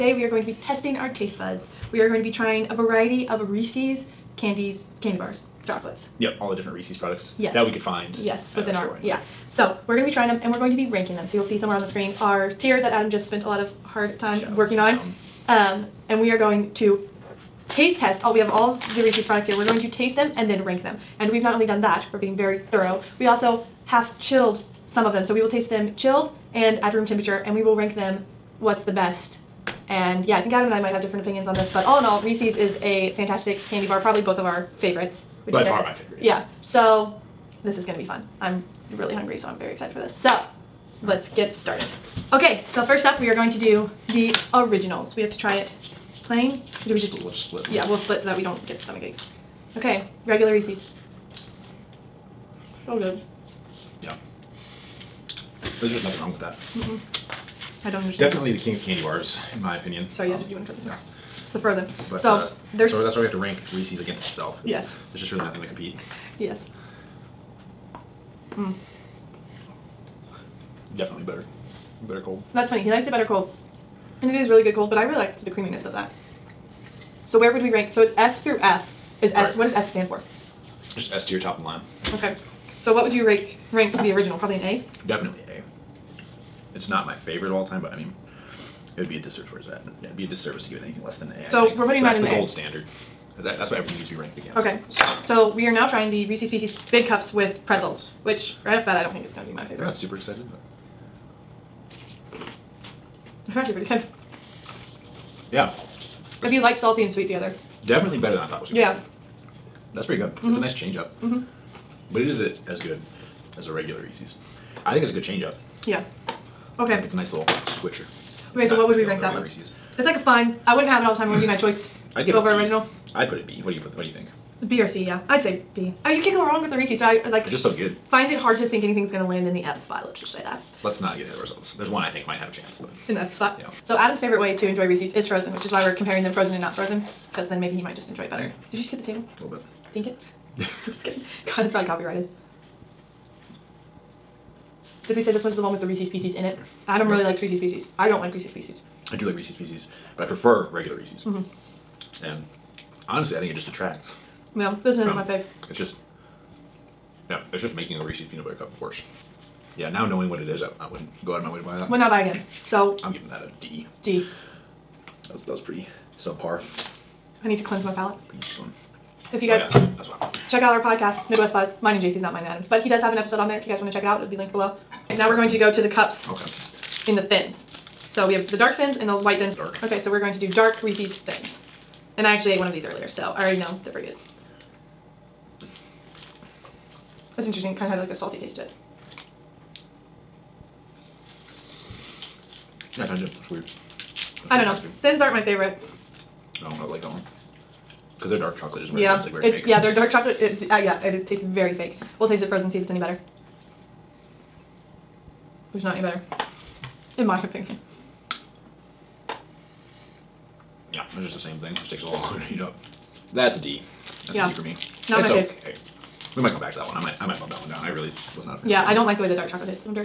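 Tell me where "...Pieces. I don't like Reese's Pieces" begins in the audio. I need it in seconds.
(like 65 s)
147 s.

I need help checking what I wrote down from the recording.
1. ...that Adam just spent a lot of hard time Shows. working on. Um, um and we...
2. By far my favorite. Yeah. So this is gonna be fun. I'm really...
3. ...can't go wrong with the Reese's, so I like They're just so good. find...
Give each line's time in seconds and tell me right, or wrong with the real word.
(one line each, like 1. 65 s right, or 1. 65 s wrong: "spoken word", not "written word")
1. 12 s right
2. 35 s right
3. 126 s right.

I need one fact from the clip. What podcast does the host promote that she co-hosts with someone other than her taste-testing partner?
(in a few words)
Midwest Buzz.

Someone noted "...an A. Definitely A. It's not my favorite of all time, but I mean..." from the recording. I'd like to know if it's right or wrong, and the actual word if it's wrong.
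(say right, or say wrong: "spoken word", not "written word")
right.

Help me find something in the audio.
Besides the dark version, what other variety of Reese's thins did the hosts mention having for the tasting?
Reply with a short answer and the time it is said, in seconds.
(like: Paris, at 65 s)
White thins, at 179 s.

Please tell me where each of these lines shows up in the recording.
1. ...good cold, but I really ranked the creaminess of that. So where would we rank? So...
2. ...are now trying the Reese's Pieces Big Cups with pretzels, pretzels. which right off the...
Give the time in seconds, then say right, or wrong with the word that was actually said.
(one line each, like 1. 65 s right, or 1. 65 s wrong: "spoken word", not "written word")
1. 74 s wrong: "liked", not "ranked"
2. 95 s right.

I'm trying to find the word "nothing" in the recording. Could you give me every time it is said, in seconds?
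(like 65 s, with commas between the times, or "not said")
56 s, 65 s.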